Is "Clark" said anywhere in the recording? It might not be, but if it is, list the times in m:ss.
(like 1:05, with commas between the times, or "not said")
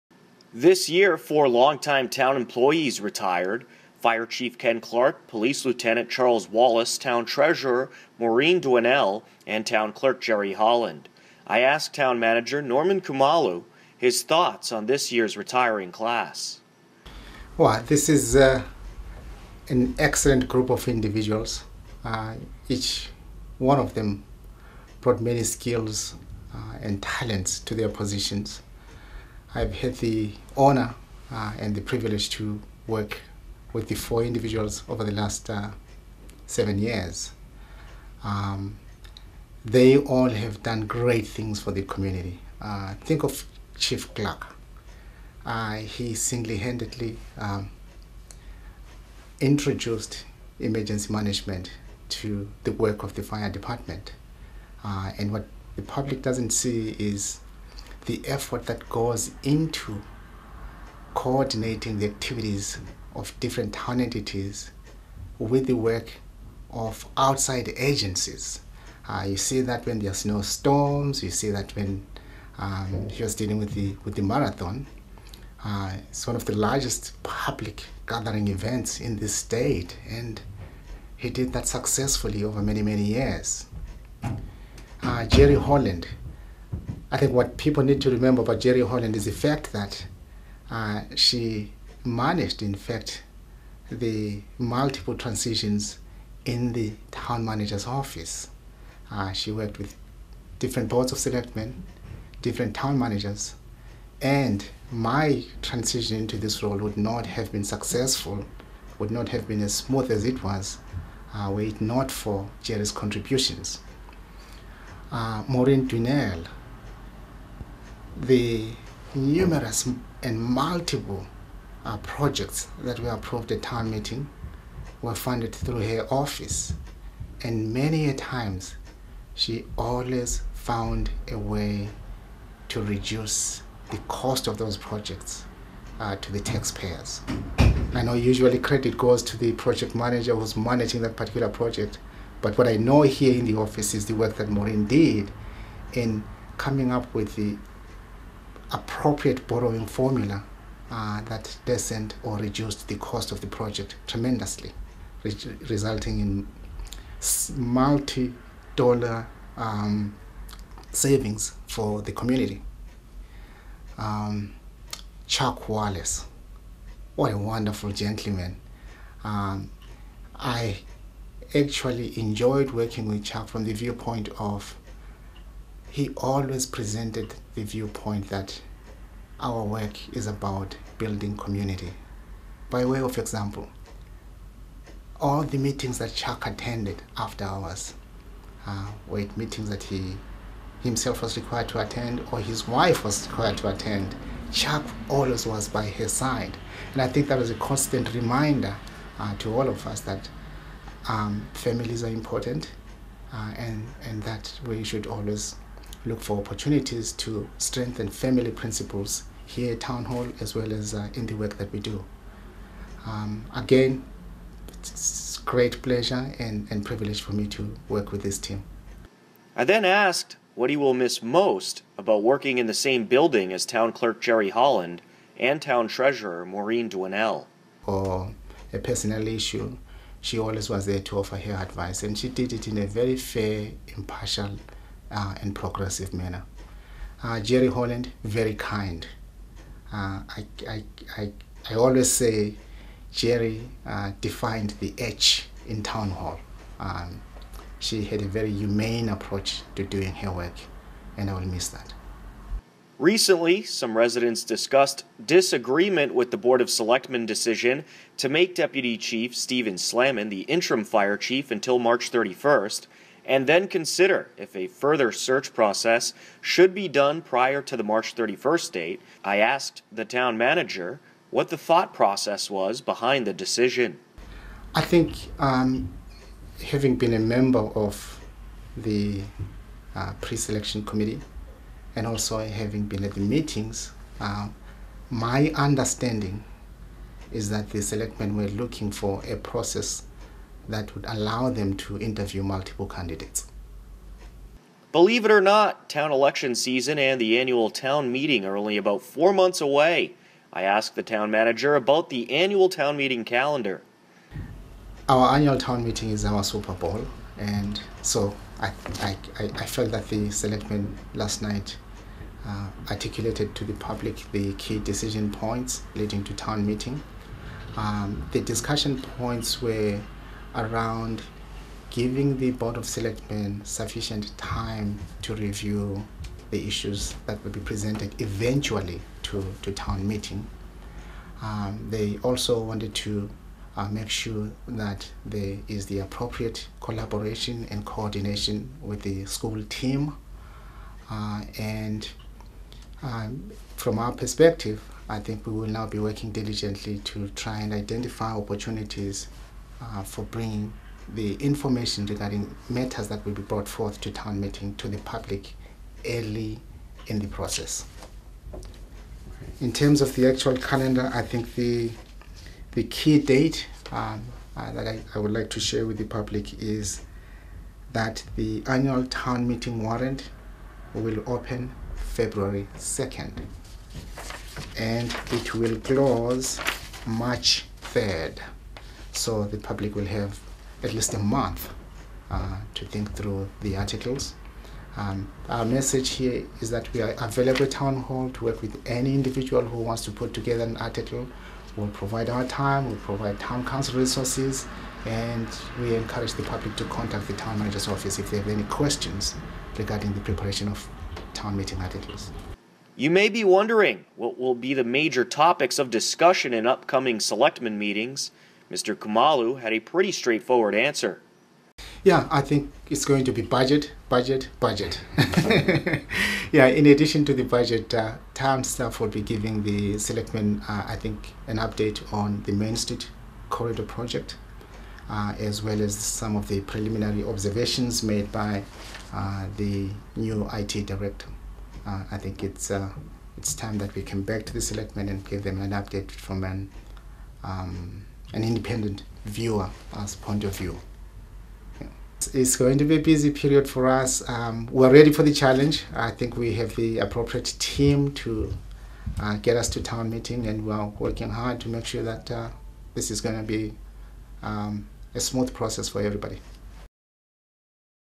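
0:04, 0:44.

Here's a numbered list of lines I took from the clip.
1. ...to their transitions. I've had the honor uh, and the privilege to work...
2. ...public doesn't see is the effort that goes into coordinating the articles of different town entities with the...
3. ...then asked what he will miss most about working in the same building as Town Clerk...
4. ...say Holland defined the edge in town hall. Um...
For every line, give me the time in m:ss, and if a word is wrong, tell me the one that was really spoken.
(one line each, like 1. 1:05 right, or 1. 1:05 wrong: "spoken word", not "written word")
1. 0:27 wrong: "positions", not "transitions"
2. 0:55 wrong: "activities", not "articles"
3. 3:39 right
4. 4:02 wrong: "Jerry", not "Holland".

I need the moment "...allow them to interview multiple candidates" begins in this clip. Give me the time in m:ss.
4:51.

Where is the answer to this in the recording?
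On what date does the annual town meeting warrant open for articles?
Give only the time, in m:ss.
6:11.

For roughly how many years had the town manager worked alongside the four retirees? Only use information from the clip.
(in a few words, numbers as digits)
7.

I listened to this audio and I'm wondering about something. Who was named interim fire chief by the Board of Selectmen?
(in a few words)
Stephen Slaman.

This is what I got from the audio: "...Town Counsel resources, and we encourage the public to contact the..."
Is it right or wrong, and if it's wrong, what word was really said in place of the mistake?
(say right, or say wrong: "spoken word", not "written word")
right.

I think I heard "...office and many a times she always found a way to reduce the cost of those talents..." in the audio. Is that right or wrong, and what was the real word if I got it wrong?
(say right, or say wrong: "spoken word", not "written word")
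wrong: "projects", not "talents".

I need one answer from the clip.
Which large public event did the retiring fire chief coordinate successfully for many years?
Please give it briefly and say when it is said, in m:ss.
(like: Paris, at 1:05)
the marathon, at 1:14.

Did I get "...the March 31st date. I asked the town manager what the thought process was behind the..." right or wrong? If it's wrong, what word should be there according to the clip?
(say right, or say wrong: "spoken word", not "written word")
right.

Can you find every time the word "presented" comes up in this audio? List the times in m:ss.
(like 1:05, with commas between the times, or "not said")
2:56, 5:27.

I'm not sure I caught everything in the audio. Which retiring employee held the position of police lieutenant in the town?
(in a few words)
Charles Wallace.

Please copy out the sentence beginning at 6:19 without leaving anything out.
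So the public will have at least a month uh, to think through the articles.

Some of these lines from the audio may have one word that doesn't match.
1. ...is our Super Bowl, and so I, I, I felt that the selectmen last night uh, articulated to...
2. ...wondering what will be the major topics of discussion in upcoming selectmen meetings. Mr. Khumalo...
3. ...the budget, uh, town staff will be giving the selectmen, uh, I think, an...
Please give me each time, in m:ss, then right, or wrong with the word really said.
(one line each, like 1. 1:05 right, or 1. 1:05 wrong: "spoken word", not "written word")
1. 5:06 right
2. 6:43 right
3. 6:57 right.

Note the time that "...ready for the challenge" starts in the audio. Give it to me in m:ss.
7:24.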